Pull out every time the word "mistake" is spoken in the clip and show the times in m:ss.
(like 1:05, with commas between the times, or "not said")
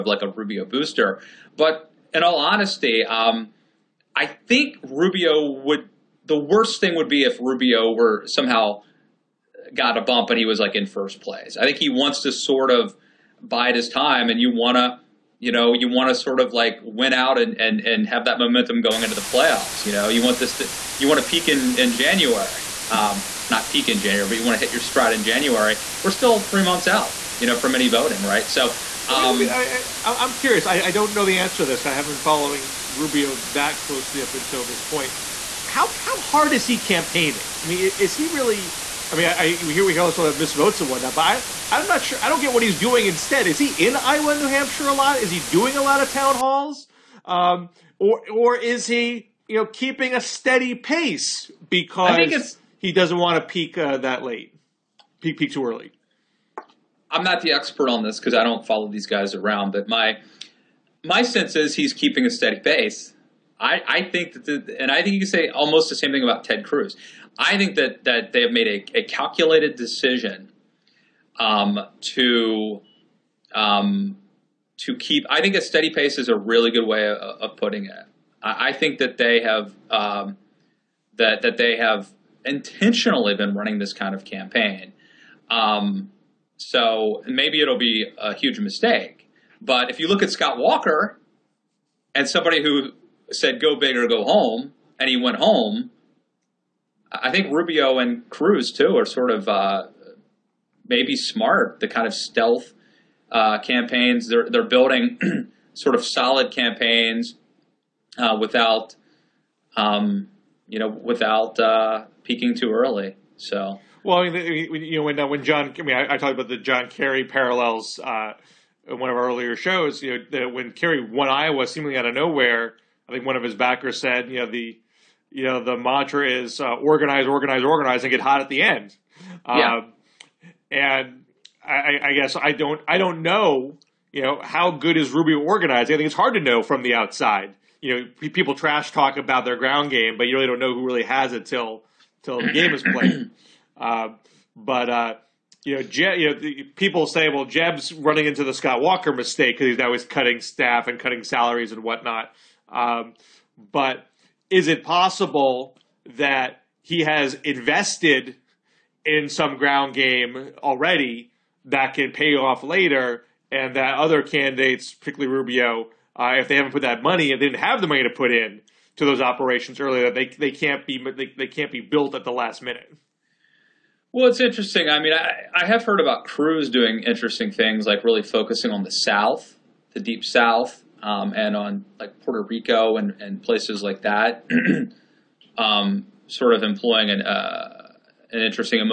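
1:28, 2:29.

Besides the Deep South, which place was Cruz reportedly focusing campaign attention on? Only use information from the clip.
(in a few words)
Puerto Rico.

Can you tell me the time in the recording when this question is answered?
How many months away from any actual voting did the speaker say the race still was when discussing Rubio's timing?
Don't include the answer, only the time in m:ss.
0:26.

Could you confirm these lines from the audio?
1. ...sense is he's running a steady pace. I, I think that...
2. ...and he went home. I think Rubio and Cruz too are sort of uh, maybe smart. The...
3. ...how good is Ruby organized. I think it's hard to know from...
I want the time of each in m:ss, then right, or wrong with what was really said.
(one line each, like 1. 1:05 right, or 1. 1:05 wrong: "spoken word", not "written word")
1. 1:01 wrong: "keeping", not "running"
2. 1:34 right
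3. 2:14 right.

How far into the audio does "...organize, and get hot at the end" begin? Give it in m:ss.
2:07.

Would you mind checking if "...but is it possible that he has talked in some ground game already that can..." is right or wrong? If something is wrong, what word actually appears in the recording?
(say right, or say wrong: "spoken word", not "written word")
wrong: "invested", not "talked".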